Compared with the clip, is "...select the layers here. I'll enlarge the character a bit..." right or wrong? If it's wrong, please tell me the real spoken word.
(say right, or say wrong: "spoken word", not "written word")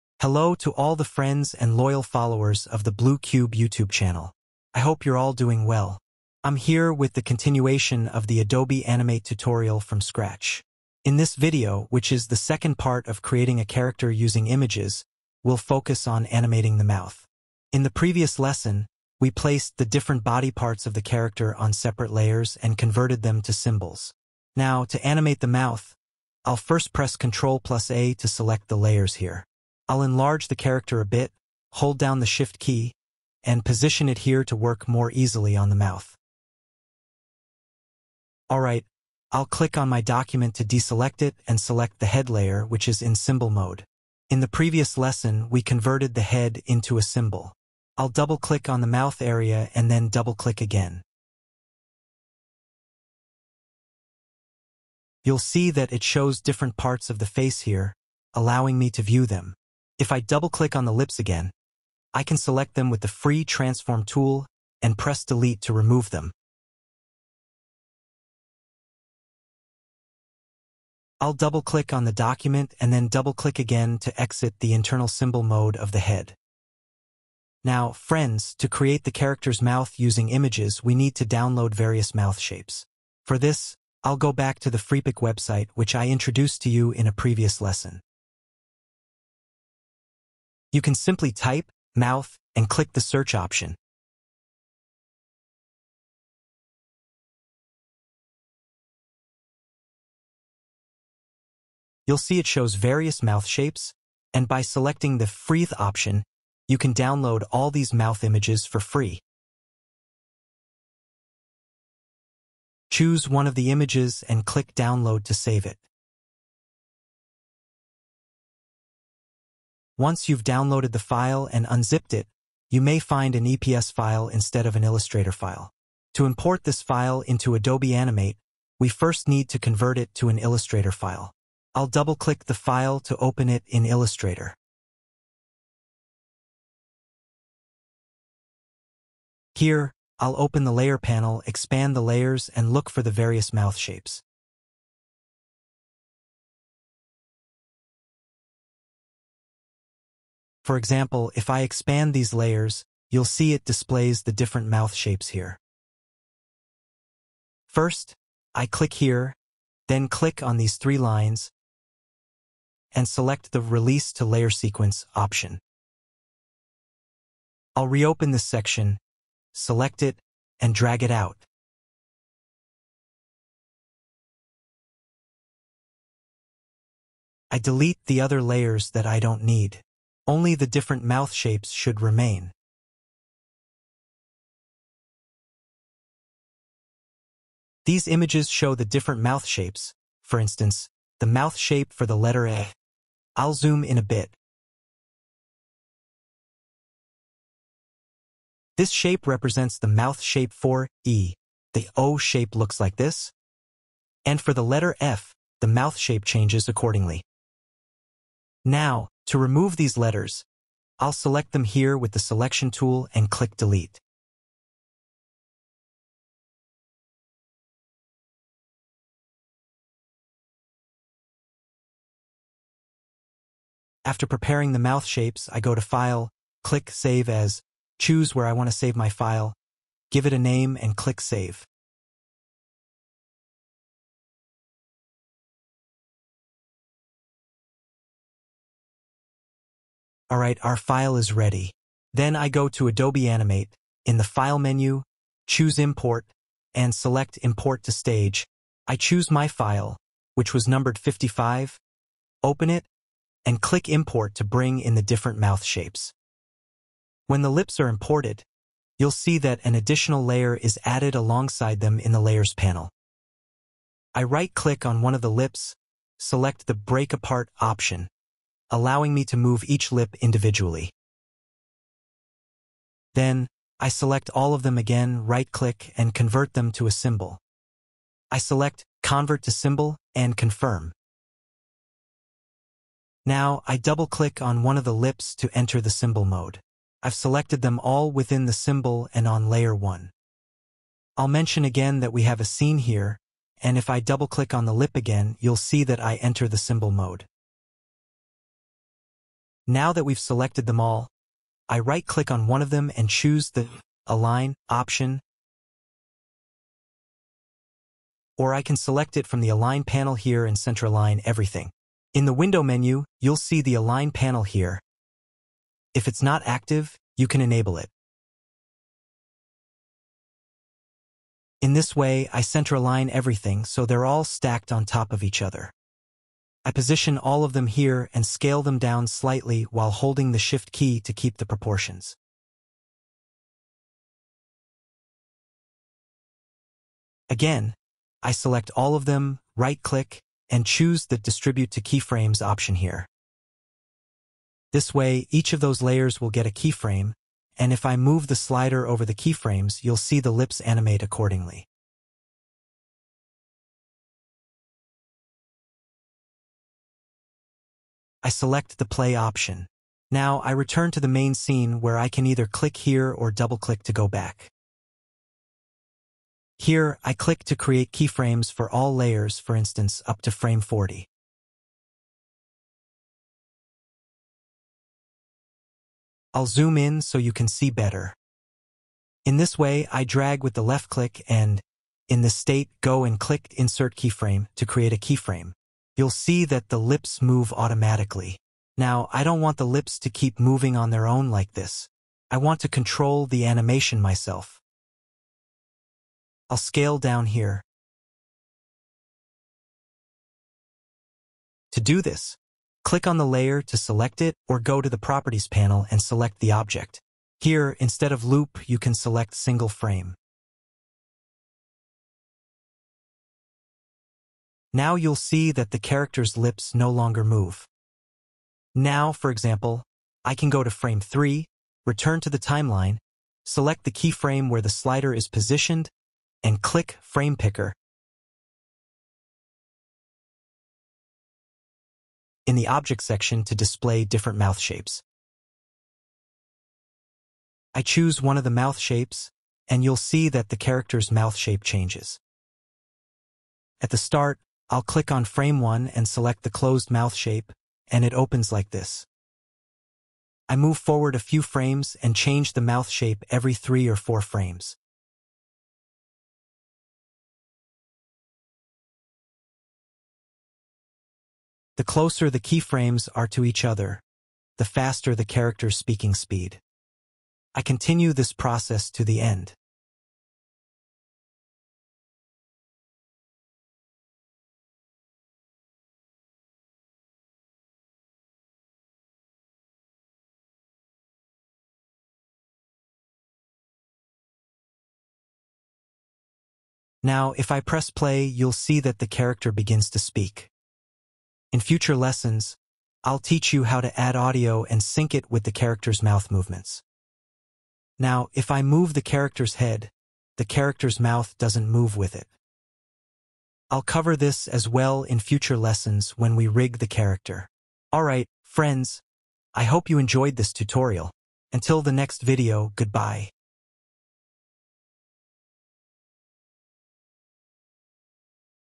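right.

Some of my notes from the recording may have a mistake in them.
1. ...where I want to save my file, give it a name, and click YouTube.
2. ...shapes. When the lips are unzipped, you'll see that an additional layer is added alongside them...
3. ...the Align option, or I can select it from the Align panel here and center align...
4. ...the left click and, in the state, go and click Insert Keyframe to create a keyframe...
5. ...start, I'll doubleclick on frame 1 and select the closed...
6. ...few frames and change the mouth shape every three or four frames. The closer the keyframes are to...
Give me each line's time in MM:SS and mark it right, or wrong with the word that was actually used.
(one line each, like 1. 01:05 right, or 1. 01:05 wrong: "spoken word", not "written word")
1. 03:48 wrong: "Save", not "YouTube"
2. 04:15 wrong: "imported", not "unzipped"
3. 05:03 right
4. 06:20 right
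5. 07:23 wrong: "click", not "doubleclick"
6. 07:31 right.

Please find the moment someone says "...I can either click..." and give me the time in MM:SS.
06:01.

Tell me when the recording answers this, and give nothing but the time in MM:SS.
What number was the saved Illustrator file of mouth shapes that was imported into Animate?
04:10.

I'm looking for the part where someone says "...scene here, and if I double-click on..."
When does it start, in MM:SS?
04:52.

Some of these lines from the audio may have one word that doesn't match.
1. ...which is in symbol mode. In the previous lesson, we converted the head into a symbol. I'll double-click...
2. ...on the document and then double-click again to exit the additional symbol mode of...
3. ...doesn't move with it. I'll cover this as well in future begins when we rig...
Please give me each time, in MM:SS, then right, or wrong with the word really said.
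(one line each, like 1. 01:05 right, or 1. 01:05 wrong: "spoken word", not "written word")
1. 00:42 right
2. 01:11 wrong: "internal", not "additional"
3. 08:21 wrong: "lessons", not "begins".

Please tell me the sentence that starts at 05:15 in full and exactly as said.
If it's not active, you can enable it.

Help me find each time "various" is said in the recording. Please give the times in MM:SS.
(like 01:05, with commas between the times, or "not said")
01:21, 01:42, 02:23.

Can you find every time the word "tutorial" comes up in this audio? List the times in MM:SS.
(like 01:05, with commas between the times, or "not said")
00:09, 08:30.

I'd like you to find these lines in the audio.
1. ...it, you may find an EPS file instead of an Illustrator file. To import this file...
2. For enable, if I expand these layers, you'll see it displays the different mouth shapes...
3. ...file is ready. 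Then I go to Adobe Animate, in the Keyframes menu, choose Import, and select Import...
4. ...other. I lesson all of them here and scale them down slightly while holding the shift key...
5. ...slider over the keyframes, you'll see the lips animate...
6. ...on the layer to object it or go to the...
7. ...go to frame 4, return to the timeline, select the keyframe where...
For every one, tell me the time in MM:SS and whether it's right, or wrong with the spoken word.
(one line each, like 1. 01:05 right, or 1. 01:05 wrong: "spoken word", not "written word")
1. 02:02 right
2. 02:30 wrong: "example", not "enable"
3. 04:00 wrong: "File", not "Keyframes"
4. 05:25 wrong: "position", not "lesson"
5. 05:48 right
6. 06:43 wrong: "select", not "object"
7. 07:00 wrong: "3", not "4".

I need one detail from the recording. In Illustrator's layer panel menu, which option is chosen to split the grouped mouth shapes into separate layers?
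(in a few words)
Release to Layer Sequence.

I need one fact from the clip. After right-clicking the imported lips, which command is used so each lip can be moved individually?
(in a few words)
Break Apart.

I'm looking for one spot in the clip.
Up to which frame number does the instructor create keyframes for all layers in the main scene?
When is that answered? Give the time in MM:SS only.
06:10.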